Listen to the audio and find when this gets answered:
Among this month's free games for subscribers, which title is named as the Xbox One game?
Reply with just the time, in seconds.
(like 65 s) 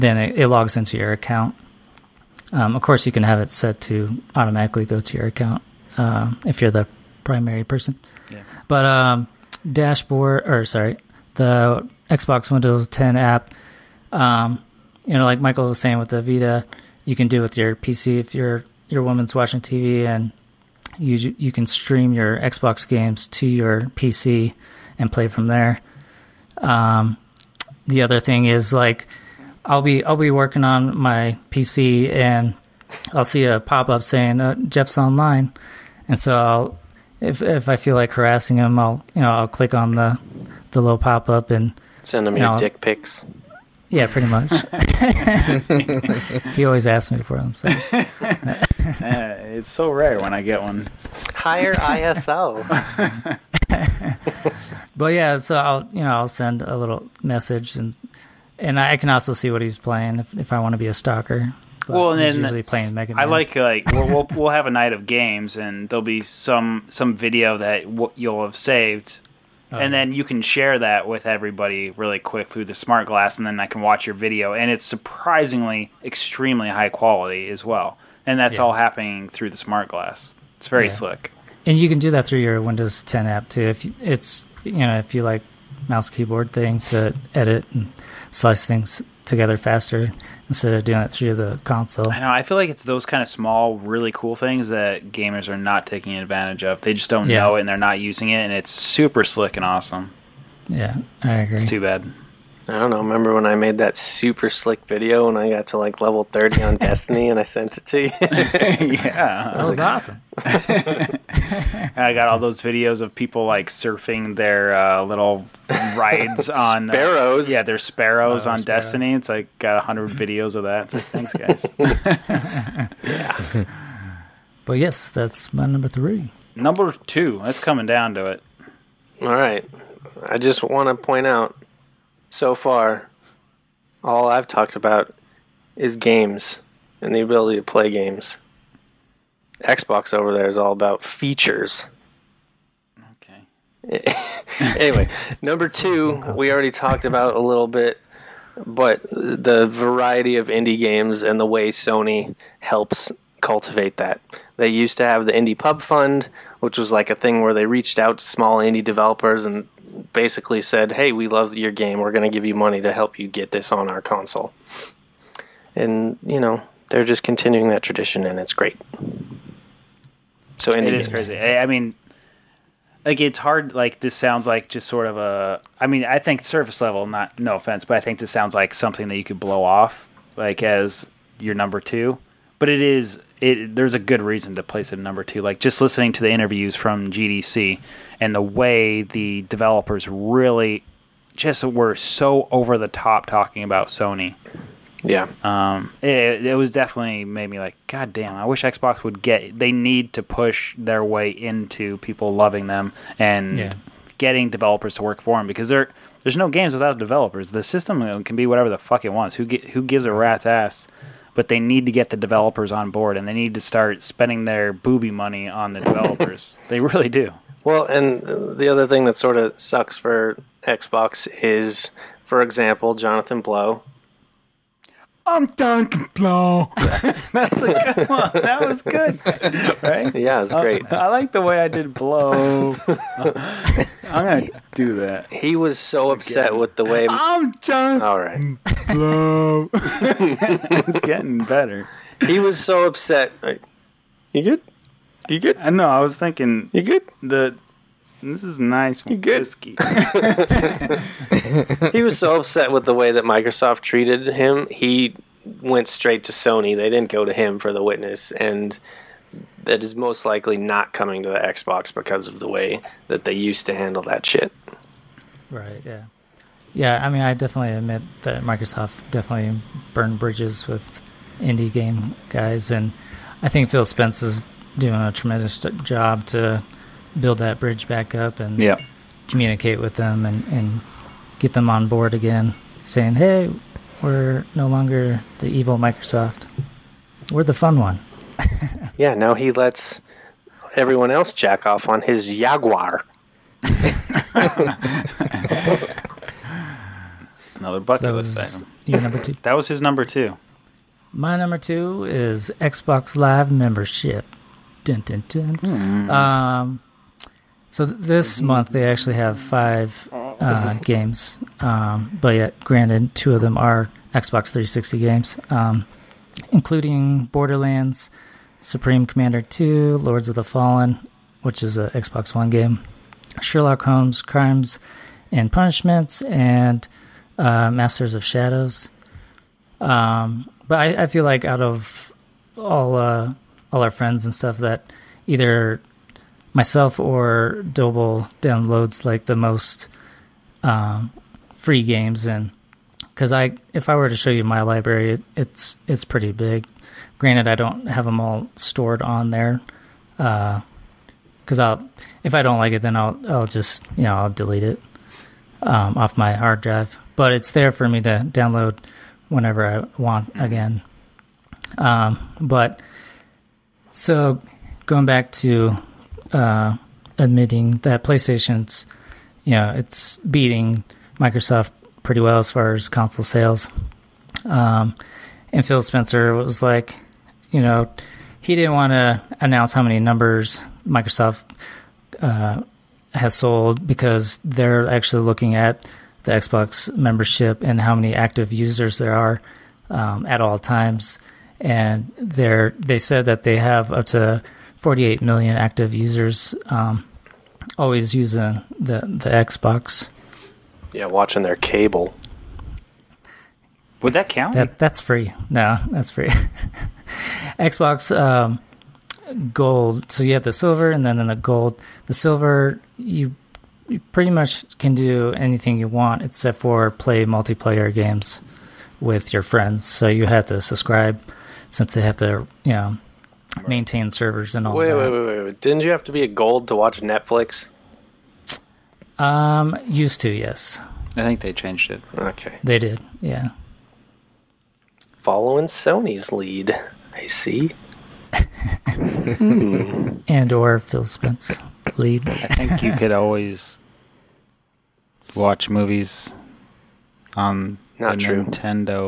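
319 s.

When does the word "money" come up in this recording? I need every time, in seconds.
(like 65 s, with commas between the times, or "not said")
162 s, 215 s.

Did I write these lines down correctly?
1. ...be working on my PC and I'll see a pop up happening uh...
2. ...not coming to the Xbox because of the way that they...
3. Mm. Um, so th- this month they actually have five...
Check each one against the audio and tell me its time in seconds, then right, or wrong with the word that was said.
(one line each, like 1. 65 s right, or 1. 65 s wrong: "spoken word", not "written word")
1. 30 s wrong: "saying", not "happening"
2. 260 s right
3. 305 s right.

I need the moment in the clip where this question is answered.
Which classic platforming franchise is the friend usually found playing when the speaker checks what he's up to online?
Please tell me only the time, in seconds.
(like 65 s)
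62 s.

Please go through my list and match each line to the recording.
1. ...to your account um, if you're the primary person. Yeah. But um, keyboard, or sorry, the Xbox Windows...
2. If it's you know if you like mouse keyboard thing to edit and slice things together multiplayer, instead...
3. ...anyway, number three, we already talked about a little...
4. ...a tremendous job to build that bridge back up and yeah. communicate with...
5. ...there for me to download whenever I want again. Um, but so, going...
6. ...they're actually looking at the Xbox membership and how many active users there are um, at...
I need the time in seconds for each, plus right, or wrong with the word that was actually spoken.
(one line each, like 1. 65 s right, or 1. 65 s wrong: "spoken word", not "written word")
1. 5 s wrong: "dashboard", not "keyboard"
2. 83 s wrong: "faster", not "multiplayer"
3. 144 s wrong: "two", not "three"
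4. 275 s right
5. 357 s right
6. 384 s right.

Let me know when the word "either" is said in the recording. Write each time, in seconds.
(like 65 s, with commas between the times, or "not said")
335 s.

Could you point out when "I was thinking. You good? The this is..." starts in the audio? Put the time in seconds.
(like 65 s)
245 s.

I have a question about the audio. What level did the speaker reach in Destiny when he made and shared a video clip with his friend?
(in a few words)
30.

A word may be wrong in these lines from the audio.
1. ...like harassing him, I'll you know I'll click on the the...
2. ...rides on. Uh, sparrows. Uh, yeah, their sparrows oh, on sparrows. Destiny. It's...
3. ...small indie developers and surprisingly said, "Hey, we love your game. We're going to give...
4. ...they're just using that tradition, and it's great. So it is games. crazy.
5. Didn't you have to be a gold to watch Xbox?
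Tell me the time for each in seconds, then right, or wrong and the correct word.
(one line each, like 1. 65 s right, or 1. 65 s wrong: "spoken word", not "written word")
1. 37 s right
2. 115 s right
3. 158 s wrong: "basically", not "surprisingly"
4. 166 s wrong: "continuing", not "using"
5. 425 s wrong: "Netflix", not "Xbox".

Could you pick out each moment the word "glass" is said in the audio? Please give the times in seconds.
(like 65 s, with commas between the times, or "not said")
73 s, 79 s.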